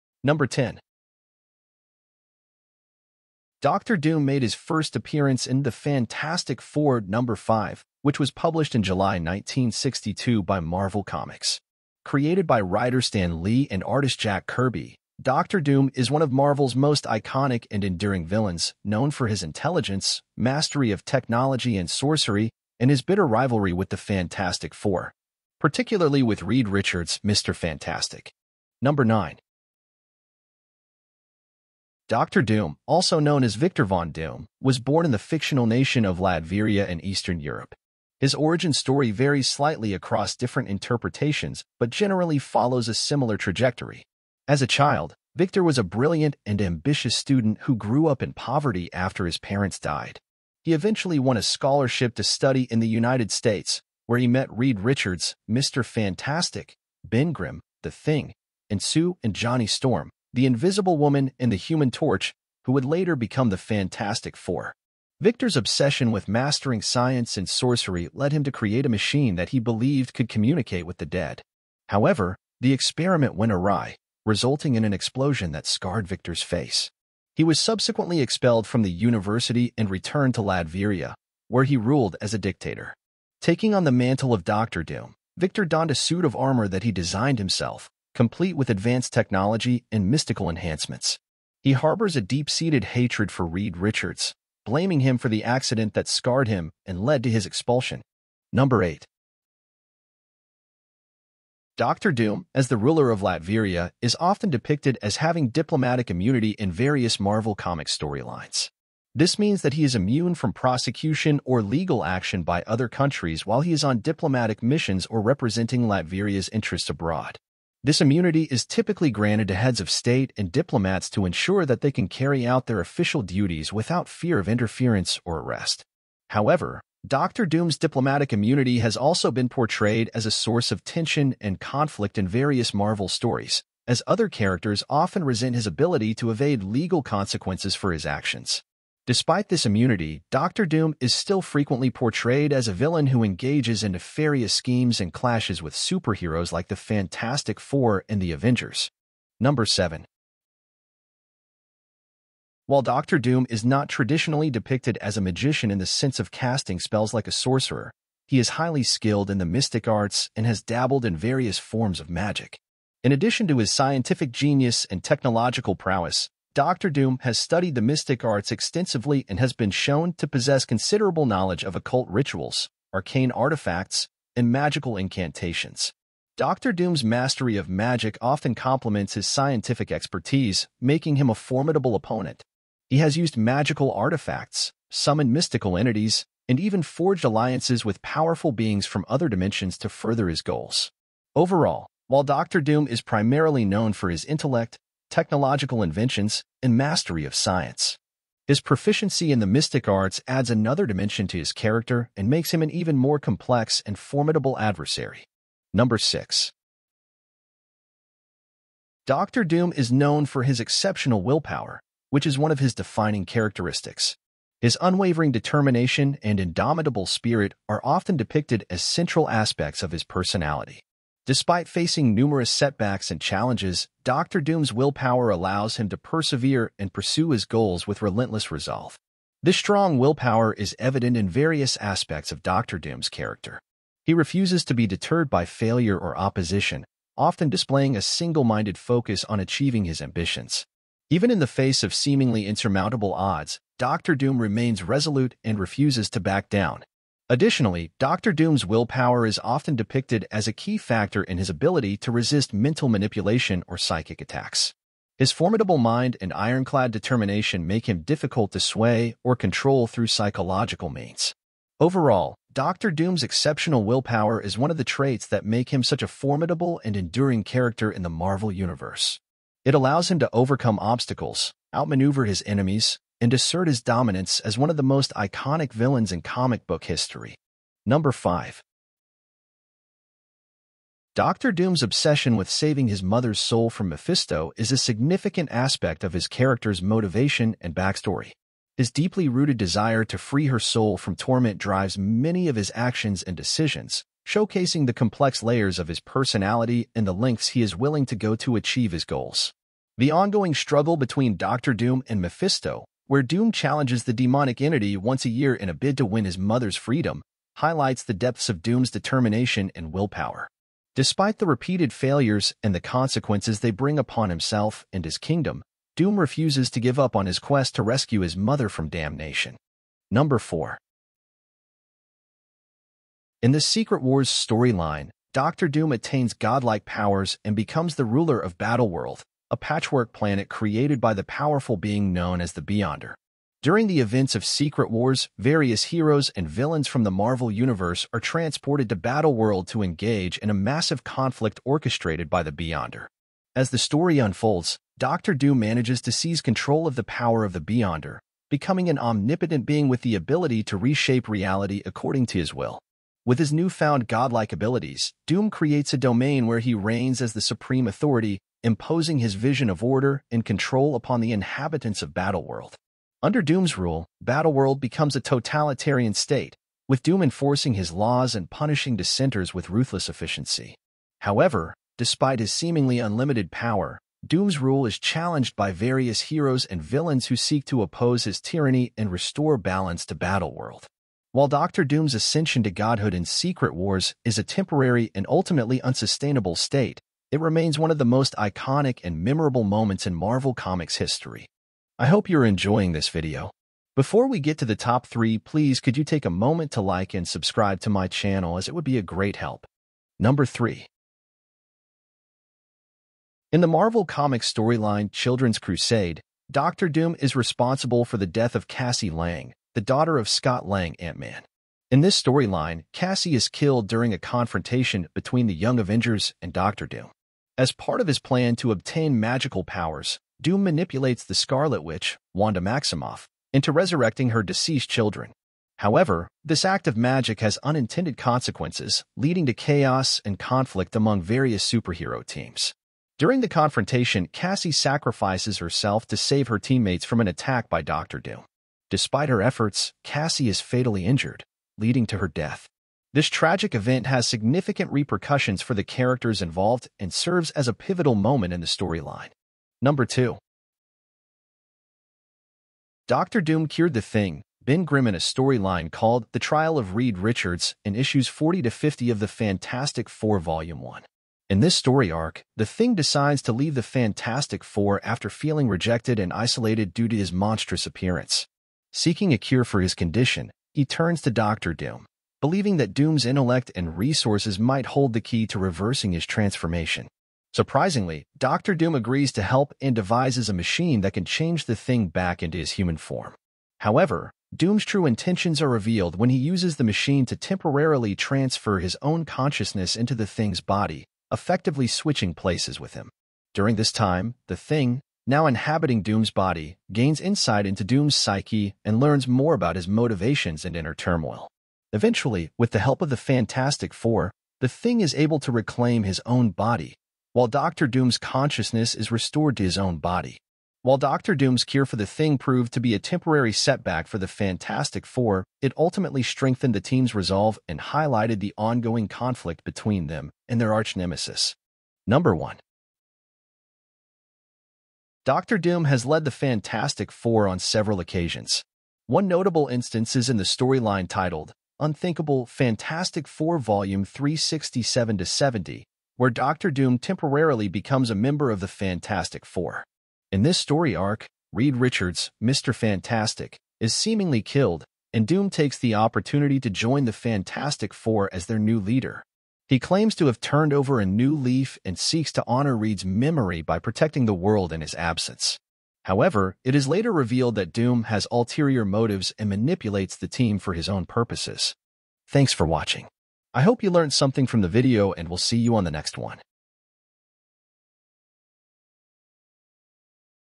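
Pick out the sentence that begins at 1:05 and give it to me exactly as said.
Victor's obsession with mastering science and sorcery led him to create a machine that he believed could communicate with the dead.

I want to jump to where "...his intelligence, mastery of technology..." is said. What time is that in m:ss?
0:19.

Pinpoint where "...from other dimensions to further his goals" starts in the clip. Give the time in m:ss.
3:08.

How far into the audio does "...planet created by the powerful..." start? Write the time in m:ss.
5:30.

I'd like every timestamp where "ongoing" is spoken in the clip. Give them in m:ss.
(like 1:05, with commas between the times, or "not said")
5:00, 8:38.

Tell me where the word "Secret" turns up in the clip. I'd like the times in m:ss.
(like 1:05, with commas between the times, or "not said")
5:23, 5:34, 6:23.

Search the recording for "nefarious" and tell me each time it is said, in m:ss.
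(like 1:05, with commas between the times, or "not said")
2:23.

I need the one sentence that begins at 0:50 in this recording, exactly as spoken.
He eventually won a scholarship to study in the United States, where he met Reed Richards, Mr.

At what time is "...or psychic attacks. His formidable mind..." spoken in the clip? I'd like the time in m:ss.
4:13.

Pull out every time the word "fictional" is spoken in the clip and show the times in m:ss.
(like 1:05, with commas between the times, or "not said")
0:35.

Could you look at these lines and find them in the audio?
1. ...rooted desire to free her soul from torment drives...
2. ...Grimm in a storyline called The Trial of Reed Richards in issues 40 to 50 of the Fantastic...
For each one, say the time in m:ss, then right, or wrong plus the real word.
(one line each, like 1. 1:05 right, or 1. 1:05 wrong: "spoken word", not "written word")
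1. 4:49 right
2. 7:34 right.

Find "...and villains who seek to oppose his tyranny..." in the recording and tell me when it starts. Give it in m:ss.
6:16.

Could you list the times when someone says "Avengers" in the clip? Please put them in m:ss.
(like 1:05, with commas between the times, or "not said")
2:28, 6:55.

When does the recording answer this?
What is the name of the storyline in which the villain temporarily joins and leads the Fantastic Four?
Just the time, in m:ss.
8:51.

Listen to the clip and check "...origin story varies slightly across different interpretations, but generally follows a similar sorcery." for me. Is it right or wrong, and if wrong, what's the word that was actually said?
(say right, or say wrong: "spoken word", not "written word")
wrong: "trajectory", not "sorcery".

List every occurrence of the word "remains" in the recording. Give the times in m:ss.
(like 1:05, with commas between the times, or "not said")
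4:04, 6:27.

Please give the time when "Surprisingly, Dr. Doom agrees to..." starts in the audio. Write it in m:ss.
7:57.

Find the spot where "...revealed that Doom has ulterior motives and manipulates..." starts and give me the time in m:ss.
9:17.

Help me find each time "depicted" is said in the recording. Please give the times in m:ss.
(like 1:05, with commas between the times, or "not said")
1:44, 2:34, 3:38, 4:09.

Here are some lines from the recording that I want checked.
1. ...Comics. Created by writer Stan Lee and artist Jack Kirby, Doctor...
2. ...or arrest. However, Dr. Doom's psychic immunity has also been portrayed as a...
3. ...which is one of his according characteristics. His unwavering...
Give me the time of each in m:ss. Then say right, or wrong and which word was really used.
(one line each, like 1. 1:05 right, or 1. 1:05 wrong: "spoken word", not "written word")
1. 0:11 right
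2. 2:05 wrong: "diplomatic", not "psychic"
3. 3:32 wrong: "defining", not "according".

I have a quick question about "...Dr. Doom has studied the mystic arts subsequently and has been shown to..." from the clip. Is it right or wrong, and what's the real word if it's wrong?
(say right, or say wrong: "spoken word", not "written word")
wrong: "extensively", not "subsequently".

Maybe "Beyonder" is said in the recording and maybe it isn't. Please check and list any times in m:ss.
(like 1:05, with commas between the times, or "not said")
5:32, 5:42, 5:47.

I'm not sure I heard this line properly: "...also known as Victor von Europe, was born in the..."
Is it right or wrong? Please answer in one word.
wrong.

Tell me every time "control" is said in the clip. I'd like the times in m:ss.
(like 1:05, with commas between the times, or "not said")
4:19, 5:46, 6:00.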